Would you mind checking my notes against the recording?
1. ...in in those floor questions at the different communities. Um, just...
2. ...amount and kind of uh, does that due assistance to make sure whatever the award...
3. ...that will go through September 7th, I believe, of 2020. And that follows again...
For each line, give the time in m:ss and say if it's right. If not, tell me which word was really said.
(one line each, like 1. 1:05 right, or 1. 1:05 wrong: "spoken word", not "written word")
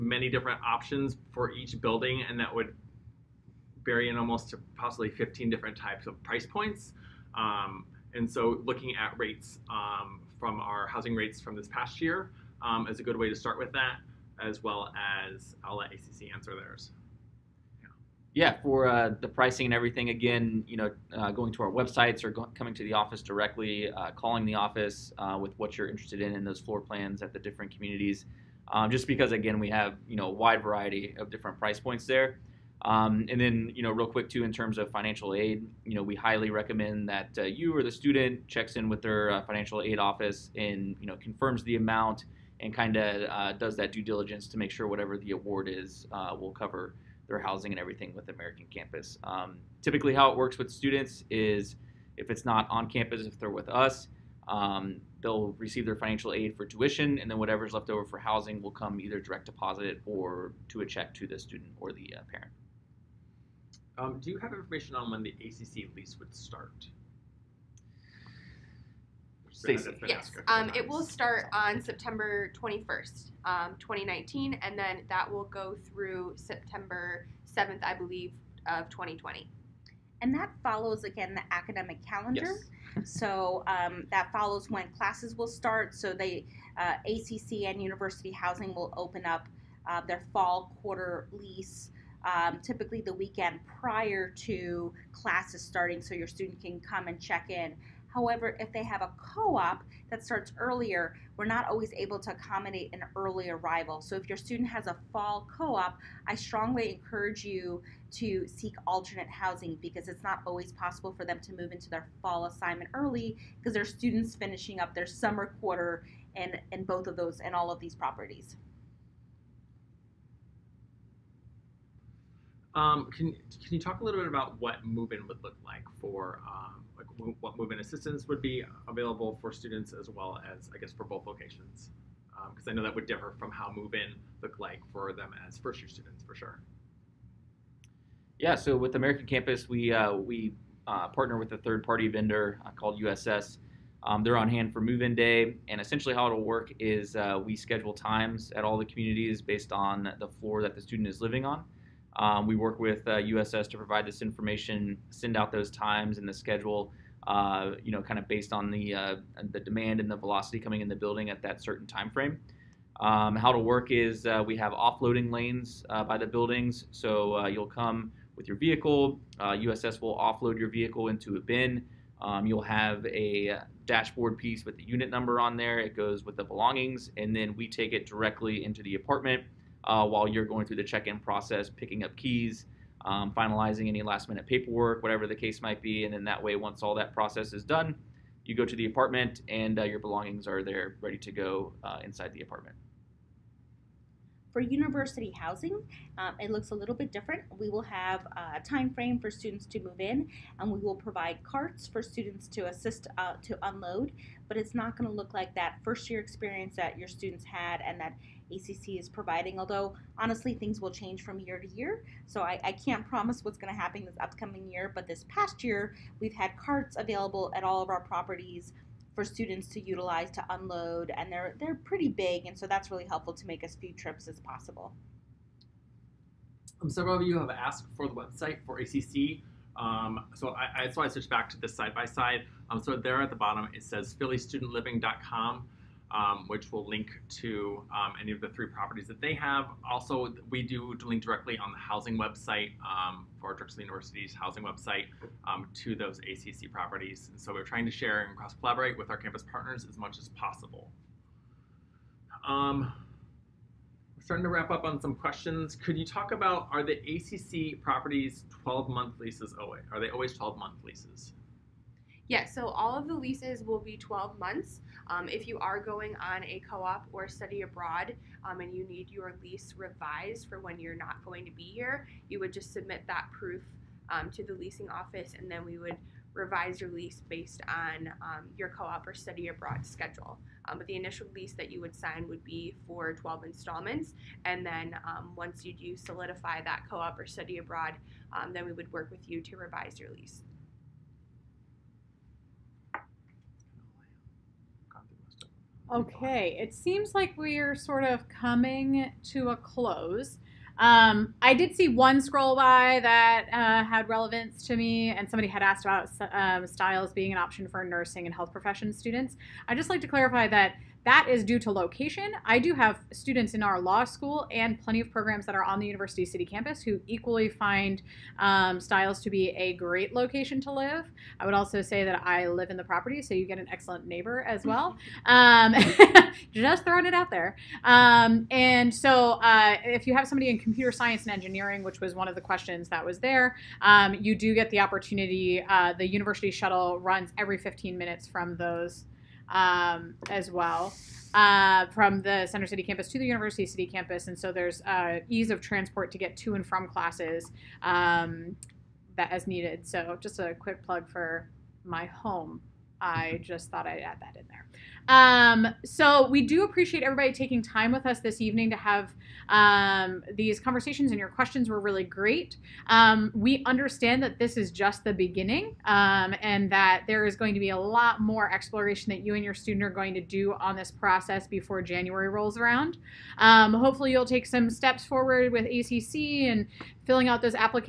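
1. 0:26 wrong: "plans", not "questions"
2. 0:41 wrong: "diligence", not "assistance"
3. 1:15 right.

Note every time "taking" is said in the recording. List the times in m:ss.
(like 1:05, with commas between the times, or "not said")
5:57.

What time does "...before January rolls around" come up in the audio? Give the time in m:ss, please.
6:11.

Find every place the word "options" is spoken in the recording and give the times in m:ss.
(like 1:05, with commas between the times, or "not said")
0:00, 5:07.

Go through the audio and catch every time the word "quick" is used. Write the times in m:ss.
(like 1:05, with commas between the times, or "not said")
0:34, 5:50.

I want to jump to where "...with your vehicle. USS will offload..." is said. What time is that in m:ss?
2:48.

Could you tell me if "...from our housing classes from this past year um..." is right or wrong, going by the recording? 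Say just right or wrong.
wrong.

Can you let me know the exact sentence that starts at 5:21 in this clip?
I would also say that I live in the property, so you get an excellent neighbor as well.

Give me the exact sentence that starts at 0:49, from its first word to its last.
Um, typically, how it works with students is if it's not on campus, if they're with us.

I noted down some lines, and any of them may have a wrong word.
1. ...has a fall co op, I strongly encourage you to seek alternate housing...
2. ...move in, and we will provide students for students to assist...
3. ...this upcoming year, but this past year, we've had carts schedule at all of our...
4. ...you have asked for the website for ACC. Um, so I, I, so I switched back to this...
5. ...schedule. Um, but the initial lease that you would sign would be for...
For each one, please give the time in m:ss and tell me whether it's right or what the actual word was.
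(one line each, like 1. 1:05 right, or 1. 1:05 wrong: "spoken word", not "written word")
1. 1:44 right
2. 3:19 wrong: "carts", not "students"
3. 3:34 wrong: "available", not "schedule"
4. 3:47 right
5. 4:39 right.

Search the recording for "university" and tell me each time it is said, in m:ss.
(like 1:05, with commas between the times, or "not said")
1:27, 3:14, 4:03, 5:15, 5:36, 5:43.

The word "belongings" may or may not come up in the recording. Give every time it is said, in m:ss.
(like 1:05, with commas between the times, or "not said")
2:56, 3:09.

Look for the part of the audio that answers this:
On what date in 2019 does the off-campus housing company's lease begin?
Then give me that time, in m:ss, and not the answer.
1:11.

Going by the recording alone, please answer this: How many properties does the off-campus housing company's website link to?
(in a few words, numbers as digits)
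3.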